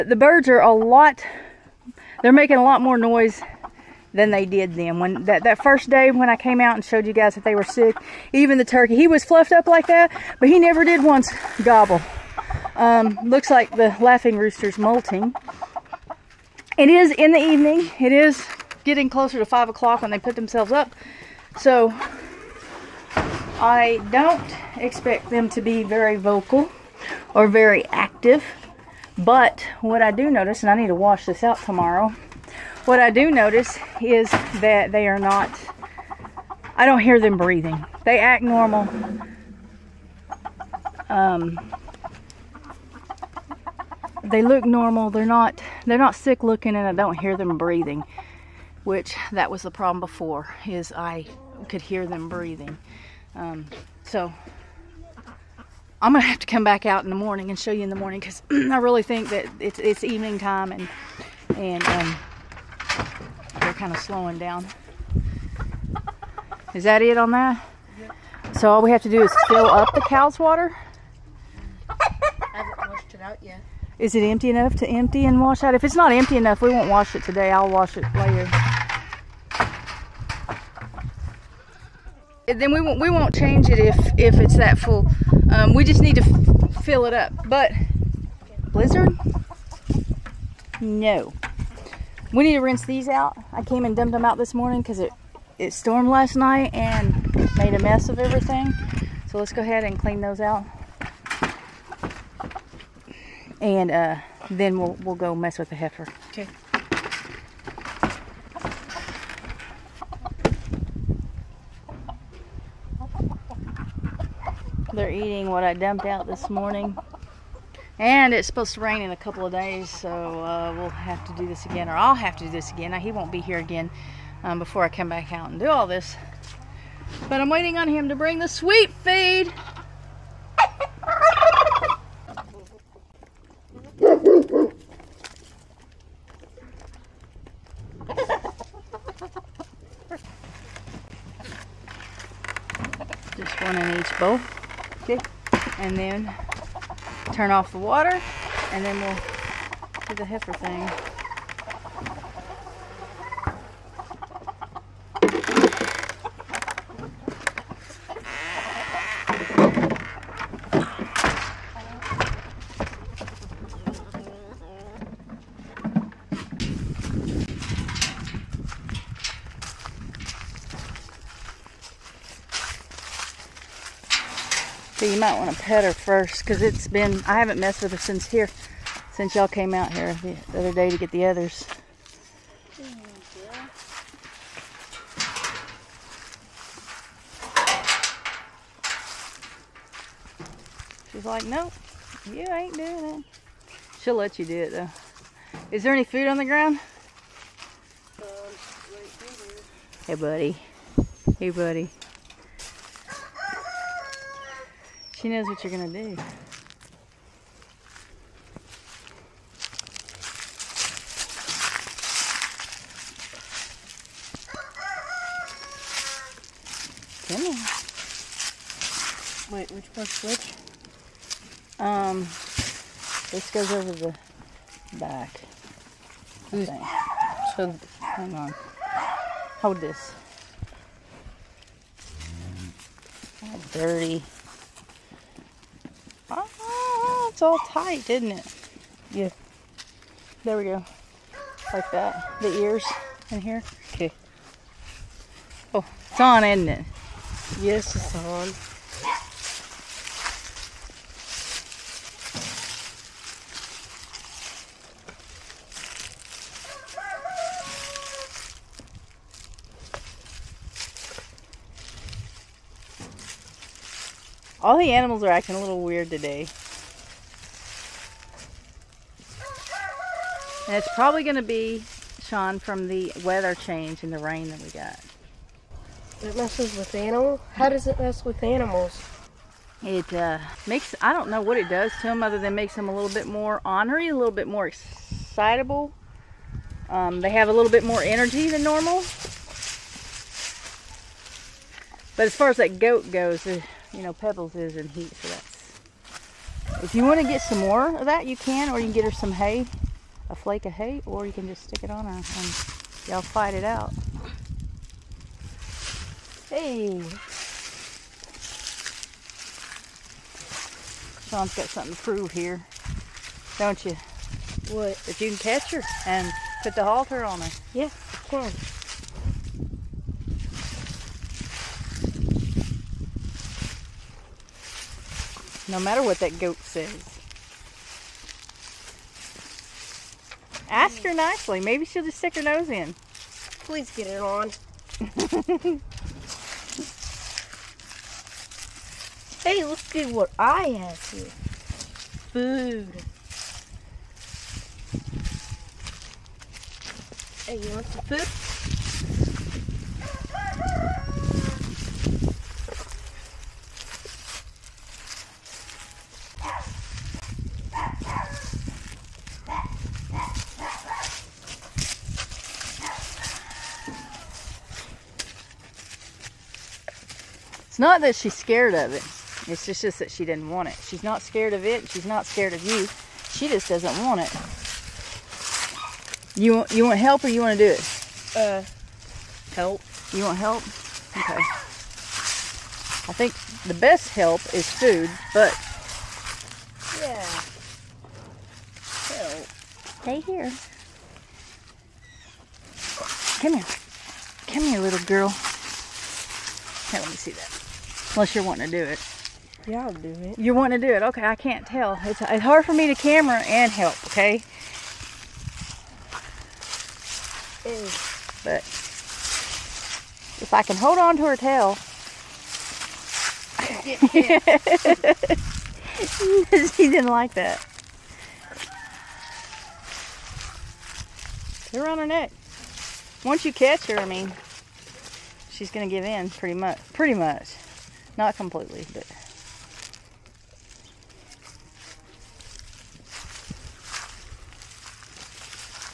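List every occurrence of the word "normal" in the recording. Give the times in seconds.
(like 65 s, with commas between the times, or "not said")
38 s, 44 s, 288 s.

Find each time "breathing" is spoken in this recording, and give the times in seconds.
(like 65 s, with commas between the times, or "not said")
37 s, 47 s, 52 s.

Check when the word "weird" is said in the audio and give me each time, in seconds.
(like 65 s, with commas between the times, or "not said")
265 s.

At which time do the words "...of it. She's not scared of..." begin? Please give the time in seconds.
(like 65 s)
371 s.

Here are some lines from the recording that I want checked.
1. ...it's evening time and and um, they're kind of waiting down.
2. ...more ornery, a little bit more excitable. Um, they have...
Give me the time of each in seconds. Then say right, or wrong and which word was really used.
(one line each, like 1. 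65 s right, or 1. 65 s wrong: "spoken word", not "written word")
1. 59 s wrong: "slowing", not "waiting"
2. 283 s right.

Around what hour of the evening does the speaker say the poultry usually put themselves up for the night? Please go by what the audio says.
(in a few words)
5 o'clock.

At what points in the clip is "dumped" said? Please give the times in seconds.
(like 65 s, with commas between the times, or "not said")
93 s, 115 s.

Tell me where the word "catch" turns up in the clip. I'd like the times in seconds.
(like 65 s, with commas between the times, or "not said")
315 s, 423 s.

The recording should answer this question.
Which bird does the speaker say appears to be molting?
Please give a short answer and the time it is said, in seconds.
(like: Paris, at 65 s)
laughing rooster, at 14 s.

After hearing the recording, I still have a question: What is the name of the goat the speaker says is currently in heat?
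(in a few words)
Pebbles.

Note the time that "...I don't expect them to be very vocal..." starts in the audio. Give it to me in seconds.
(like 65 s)
23 s.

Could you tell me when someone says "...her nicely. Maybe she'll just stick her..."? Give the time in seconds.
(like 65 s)
331 s.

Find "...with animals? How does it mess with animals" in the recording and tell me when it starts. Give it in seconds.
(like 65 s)
276 s.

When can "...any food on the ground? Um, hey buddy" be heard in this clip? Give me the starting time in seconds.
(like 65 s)
195 s.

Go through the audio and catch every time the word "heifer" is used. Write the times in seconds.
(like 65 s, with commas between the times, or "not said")
105 s, 150 s.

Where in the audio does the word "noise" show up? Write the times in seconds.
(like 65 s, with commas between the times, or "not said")
2 s.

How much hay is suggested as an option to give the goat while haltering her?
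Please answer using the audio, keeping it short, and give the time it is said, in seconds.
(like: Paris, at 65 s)
a flake, at 300 s.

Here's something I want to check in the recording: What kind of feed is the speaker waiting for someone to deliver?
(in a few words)
sweet feed.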